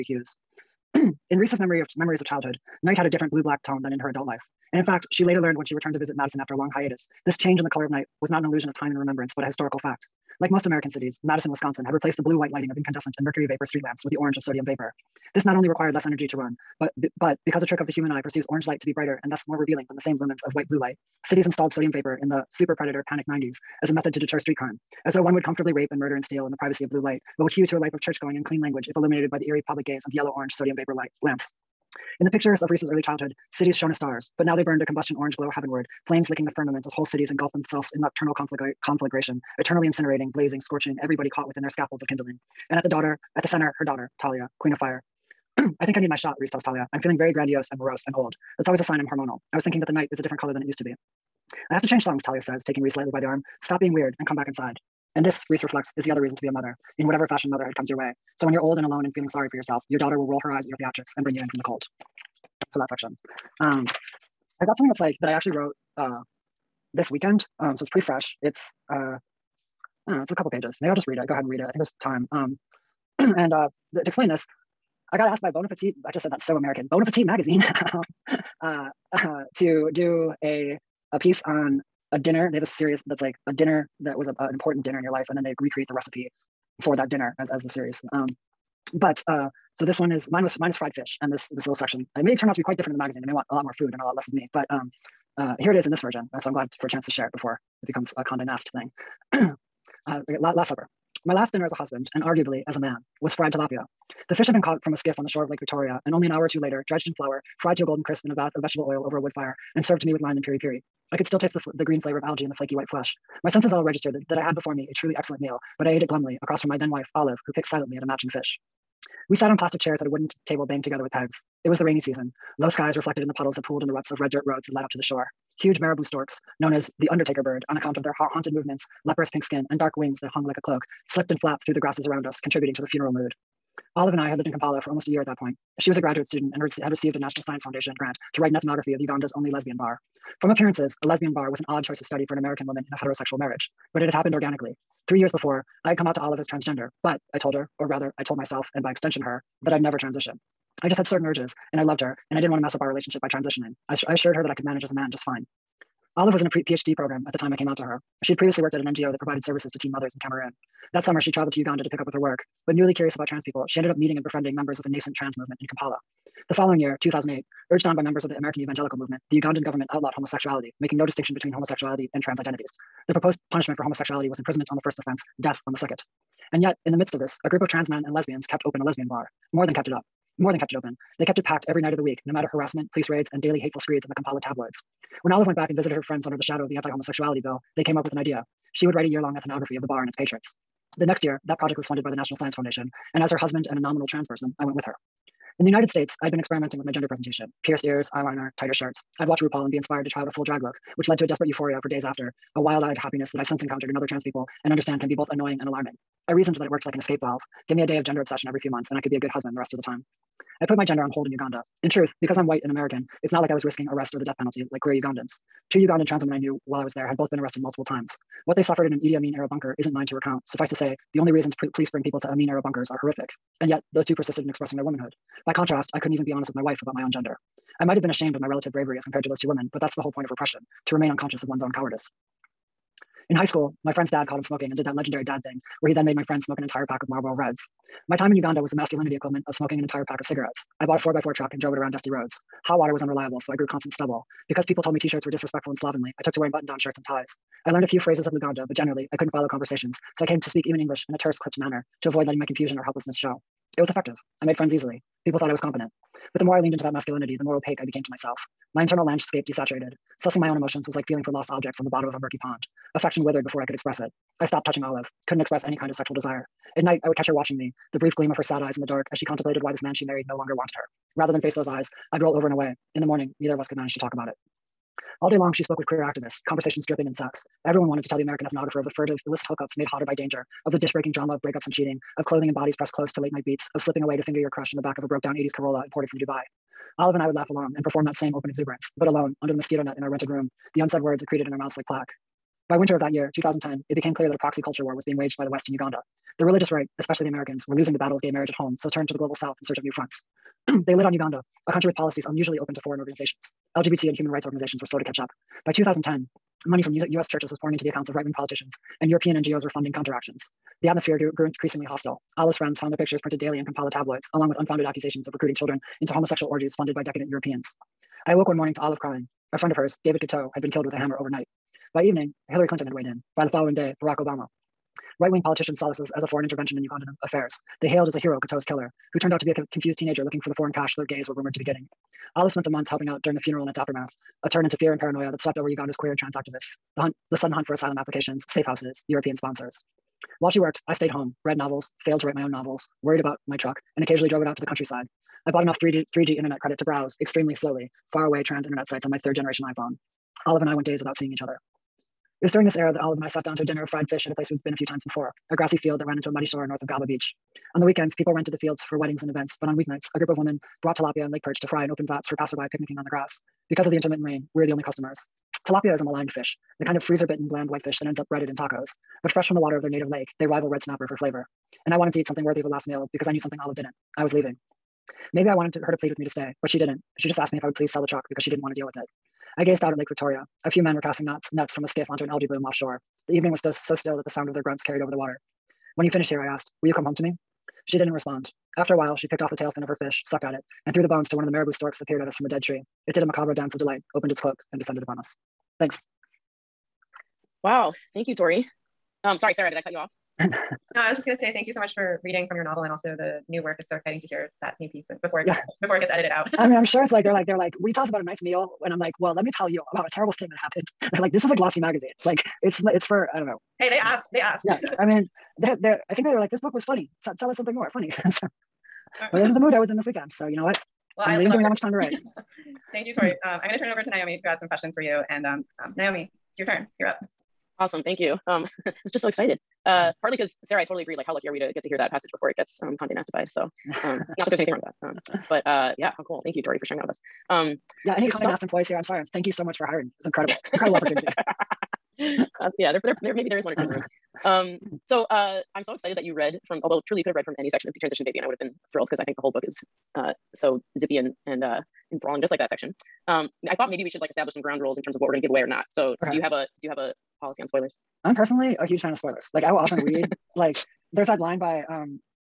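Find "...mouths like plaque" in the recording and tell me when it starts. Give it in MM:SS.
04:51.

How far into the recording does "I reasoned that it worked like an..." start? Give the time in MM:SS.
03:26.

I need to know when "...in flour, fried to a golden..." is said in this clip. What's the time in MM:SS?
01:47.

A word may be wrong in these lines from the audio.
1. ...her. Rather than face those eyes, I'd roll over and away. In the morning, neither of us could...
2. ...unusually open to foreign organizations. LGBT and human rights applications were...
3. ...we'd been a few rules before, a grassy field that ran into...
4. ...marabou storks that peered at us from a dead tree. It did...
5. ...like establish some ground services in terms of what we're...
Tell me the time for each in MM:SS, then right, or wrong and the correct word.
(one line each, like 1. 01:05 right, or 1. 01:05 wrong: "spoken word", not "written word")
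1. 04:30 right
2. 05:02 wrong: "organizations", not "applications"
3. 05:54 wrong: "times", not "rules"
4. 06:31 right
5. 07:34 wrong: "rules", not "services".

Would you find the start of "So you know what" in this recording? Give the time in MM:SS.
07:00.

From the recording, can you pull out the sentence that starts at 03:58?
My time in Uganda was the masculinity equivalent of smoking an entire pack of cigarettes.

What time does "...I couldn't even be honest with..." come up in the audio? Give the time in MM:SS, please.
03:45.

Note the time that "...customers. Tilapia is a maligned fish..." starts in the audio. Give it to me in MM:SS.
06:04.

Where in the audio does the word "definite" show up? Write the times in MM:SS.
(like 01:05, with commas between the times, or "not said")
not said.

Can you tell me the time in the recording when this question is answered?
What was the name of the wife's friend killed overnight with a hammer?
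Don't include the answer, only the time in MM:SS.
05:20.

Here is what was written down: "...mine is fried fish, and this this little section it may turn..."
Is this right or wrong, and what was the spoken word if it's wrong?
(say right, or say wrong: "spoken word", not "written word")
right.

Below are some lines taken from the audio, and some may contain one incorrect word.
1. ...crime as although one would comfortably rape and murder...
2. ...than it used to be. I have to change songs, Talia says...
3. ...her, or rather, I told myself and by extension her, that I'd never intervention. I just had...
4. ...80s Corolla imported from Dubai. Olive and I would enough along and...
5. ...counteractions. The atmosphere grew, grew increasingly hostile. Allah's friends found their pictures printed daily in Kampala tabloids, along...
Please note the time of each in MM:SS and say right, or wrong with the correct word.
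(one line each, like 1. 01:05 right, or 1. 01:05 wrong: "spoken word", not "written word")
1. 00:24 wrong: "though", not "although"
2. 00:50 right
3. 02:27 wrong: "transition", not "intervention"
4. 04:45 wrong: "laugh", not "enough"
5. 05:09 right.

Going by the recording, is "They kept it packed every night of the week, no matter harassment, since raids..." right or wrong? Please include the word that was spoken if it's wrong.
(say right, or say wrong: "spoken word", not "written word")
wrong: "police", not "since".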